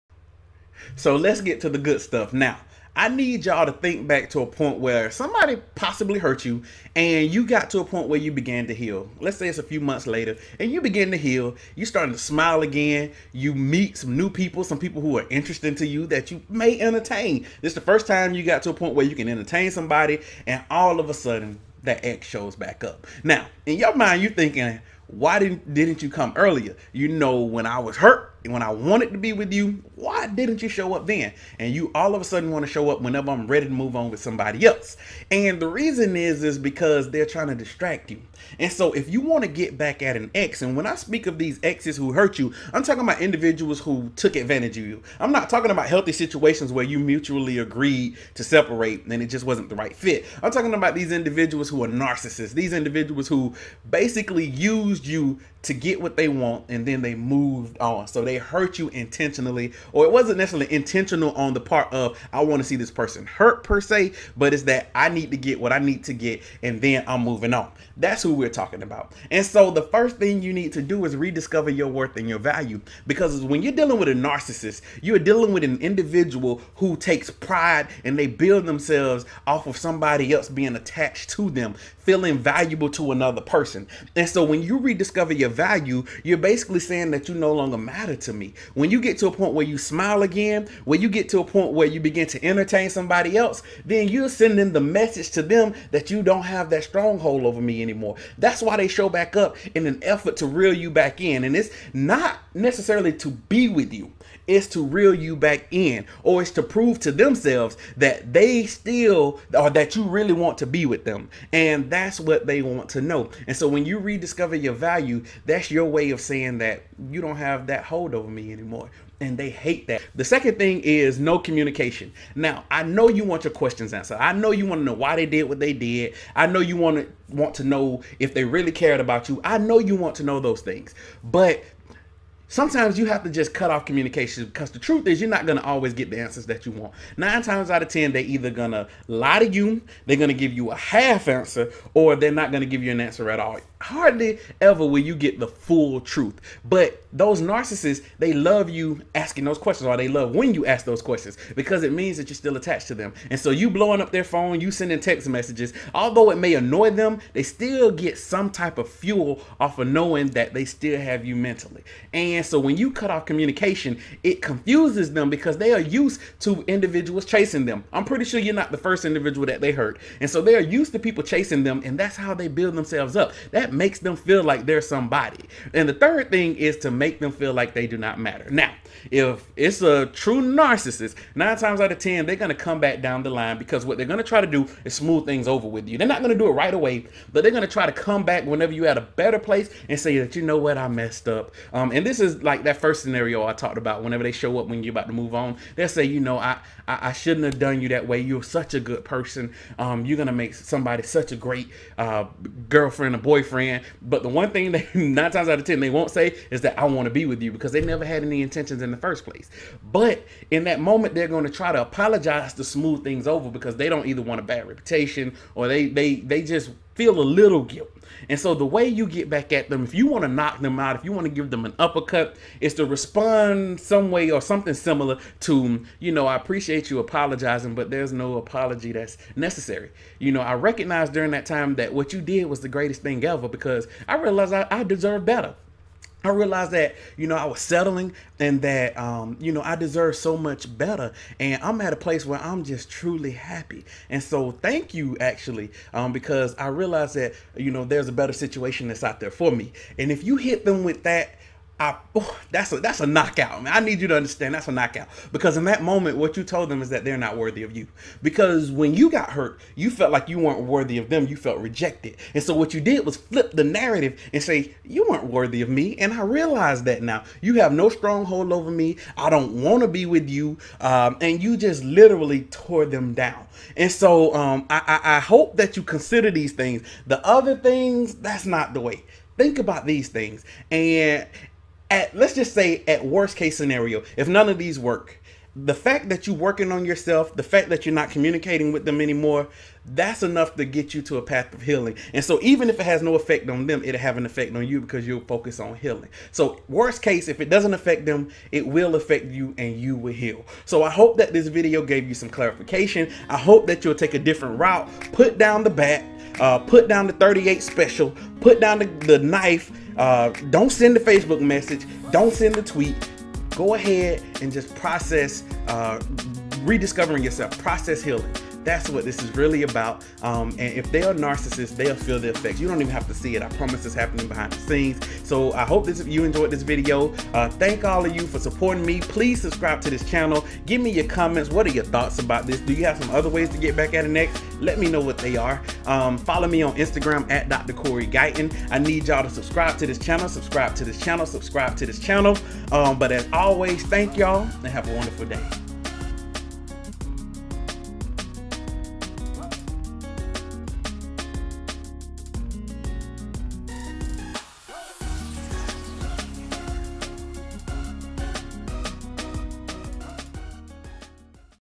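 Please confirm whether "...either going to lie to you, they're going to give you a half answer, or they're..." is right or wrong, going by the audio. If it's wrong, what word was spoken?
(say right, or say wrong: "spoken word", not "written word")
right.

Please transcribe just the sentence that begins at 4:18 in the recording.
Because when you got hurt, you felt like you weren't worthy of them.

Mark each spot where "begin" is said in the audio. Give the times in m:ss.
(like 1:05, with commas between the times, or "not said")
0:10, 1:31.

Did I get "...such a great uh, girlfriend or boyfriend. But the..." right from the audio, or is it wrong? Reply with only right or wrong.
right.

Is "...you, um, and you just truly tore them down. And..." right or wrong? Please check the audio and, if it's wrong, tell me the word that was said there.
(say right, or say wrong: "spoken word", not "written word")
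wrong: "literally", not "truly".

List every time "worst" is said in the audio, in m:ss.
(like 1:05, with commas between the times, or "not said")
4:43, 4:56.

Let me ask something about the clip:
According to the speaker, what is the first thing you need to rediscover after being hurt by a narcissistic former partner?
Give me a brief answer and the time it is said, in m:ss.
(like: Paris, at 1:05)
Your worth and your value, at 1:11.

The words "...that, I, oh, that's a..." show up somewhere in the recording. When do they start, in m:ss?
4:11.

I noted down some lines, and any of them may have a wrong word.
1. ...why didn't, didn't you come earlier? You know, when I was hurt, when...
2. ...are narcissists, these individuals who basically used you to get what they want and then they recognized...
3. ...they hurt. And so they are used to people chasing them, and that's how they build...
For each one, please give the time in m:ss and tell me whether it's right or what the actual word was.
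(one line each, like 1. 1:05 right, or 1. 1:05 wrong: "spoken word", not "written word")
1. 0:25 right
2. 0:51 wrong: "moved", not "recognized"
3. 2:49 right.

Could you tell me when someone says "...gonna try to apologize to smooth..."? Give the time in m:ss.
3:31.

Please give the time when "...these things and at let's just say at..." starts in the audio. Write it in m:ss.
4:39.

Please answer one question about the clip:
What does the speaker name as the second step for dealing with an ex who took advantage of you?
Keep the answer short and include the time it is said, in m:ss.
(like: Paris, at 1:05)
No communication, at 2:01.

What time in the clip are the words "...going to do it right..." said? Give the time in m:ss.
3:06.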